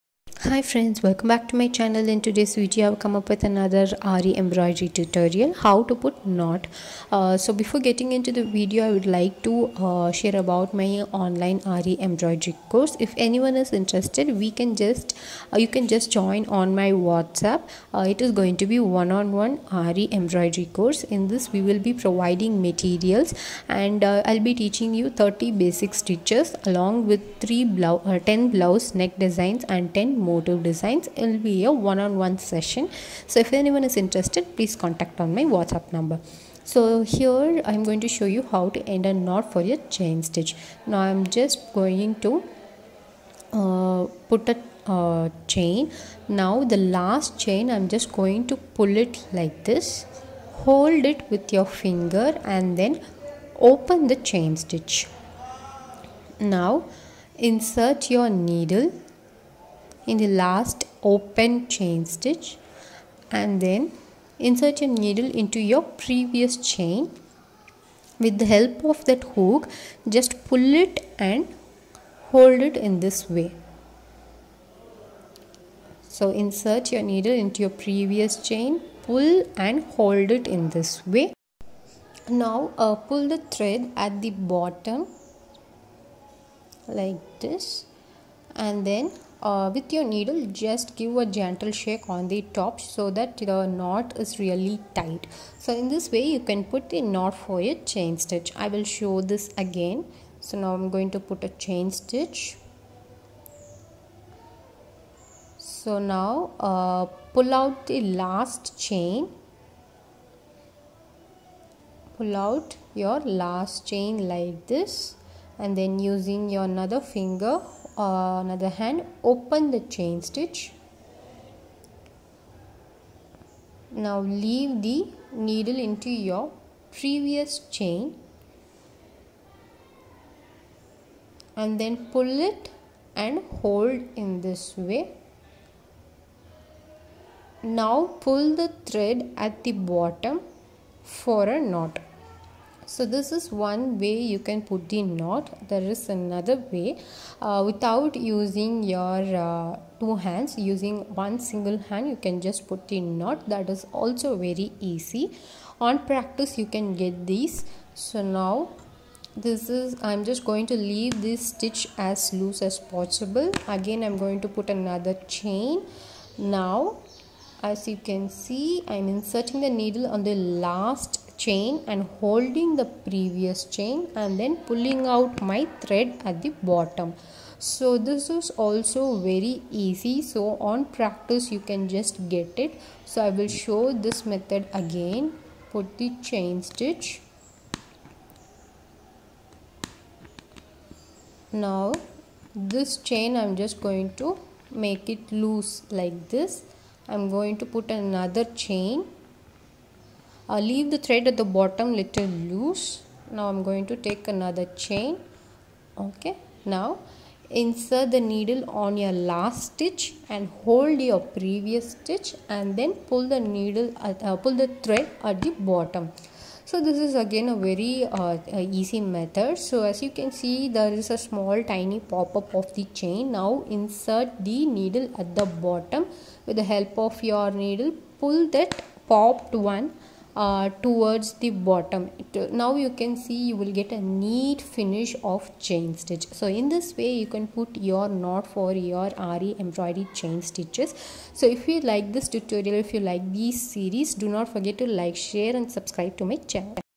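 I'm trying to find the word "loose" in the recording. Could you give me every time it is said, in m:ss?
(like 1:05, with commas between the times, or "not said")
2:42, 3:15, 3:22.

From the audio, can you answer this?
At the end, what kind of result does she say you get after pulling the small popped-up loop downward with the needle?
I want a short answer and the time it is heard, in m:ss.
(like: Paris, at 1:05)
a neat finish, at 3:54.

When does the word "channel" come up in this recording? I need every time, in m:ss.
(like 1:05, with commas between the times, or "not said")
0:01, 4:06.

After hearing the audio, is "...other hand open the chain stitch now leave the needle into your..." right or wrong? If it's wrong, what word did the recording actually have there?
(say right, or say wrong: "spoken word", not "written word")
right.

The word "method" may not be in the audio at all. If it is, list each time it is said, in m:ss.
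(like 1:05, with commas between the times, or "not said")
3:04, 3:39.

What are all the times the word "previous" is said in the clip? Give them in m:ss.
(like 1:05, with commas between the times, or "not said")
1:05, 1:17, 2:06, 2:53, 3:31.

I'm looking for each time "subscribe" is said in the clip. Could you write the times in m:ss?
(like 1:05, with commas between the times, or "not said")
4:05.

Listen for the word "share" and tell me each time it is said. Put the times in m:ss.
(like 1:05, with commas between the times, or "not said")
0:10, 4:05.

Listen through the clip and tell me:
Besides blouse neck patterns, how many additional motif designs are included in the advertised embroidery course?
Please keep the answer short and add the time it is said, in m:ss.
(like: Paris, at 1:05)
10, at 0:30.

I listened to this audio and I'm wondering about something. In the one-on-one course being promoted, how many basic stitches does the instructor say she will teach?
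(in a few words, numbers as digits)
30.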